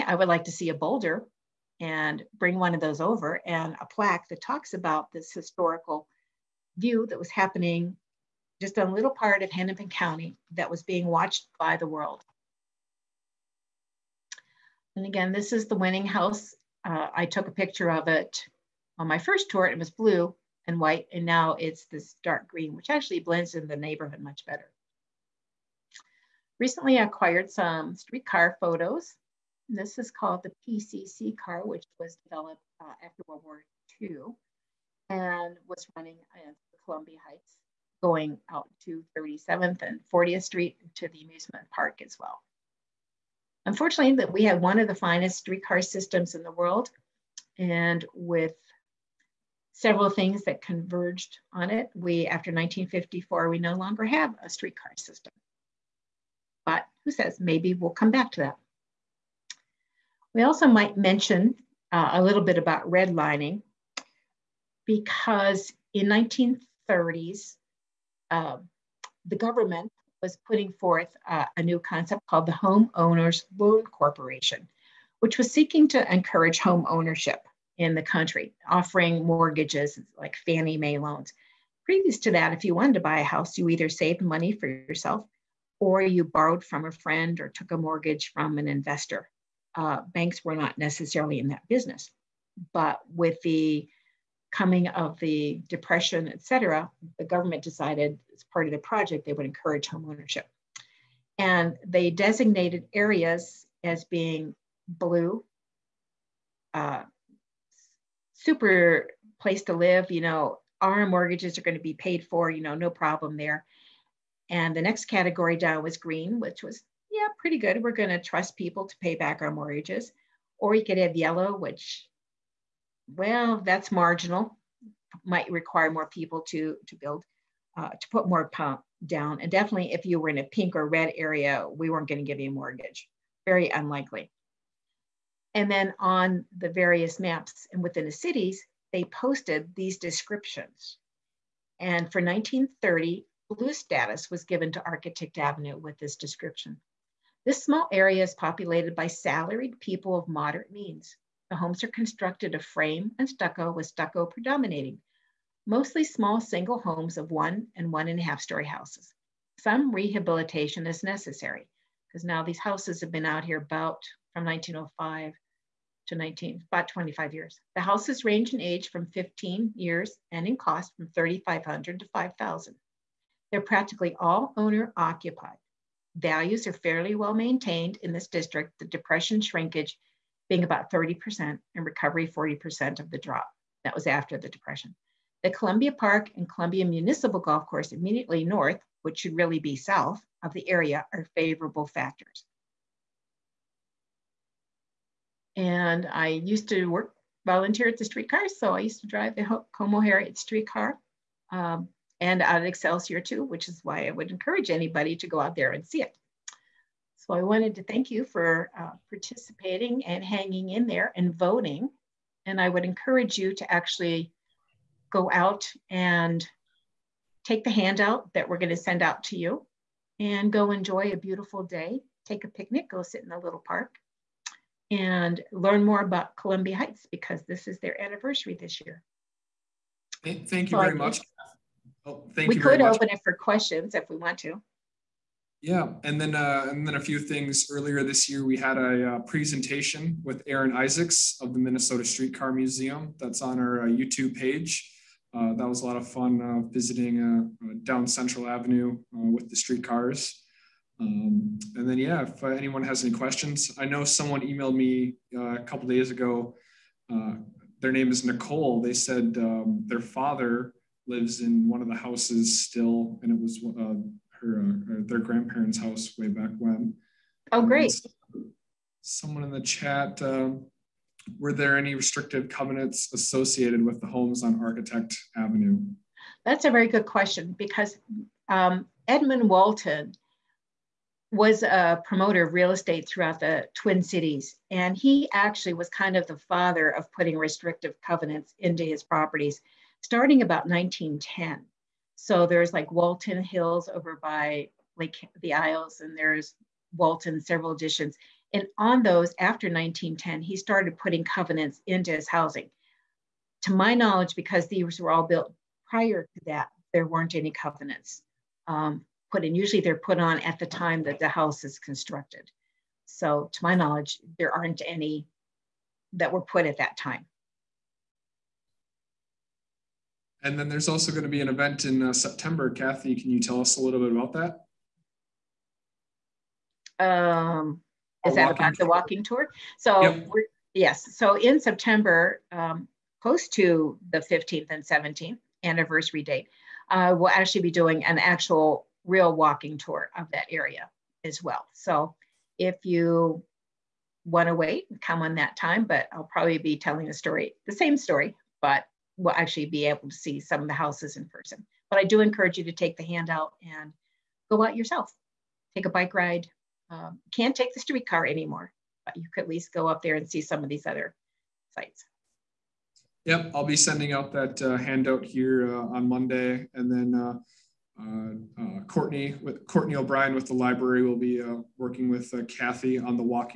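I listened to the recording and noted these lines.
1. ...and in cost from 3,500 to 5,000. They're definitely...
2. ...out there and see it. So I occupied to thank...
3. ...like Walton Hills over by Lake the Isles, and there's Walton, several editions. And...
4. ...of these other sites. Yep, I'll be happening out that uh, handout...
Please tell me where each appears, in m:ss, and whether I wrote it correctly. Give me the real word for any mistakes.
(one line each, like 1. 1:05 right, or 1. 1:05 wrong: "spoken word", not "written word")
1. 2:50 wrong: "practically", not "definitely"
2. 3:25 wrong: "wanted", not "occupied"
3. 4:52 right
4. 6:00 wrong: "sending", not "happening".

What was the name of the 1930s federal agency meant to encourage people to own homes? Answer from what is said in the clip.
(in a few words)
Homeowners Loan Corporation.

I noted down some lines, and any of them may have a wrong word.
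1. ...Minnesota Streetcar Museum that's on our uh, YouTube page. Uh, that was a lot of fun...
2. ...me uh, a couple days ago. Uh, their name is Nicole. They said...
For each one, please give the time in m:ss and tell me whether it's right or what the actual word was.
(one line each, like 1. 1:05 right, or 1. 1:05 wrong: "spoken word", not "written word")
1. 4:01 right
2. 4:14 right.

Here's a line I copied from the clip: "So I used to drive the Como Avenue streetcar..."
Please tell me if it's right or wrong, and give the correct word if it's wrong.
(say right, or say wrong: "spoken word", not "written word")
wrong: "Harriet", not "Avenue".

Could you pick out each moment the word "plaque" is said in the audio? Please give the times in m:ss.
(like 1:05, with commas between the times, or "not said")
0:03.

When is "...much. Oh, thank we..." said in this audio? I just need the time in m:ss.
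3:50.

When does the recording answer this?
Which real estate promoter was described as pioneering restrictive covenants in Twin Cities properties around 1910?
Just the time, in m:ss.
4:39.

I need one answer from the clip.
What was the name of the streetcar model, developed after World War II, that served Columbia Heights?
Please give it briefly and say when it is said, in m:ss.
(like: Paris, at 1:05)
PCC car, at 0:30.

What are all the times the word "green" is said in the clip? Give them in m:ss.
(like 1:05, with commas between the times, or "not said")
0:22, 1:55.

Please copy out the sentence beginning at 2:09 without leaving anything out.
And definitely if you were in a pink or red area, we weren't going to give you a mortgage.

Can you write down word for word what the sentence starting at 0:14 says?
And again, this is the winning house.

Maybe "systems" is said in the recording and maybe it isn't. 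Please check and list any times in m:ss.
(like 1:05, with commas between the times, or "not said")
0:45, 0:54.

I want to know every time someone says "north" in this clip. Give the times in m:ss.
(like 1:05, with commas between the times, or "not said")
3:08.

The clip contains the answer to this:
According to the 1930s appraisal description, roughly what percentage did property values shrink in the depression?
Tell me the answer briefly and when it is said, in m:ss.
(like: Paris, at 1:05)
30%, at 3:00.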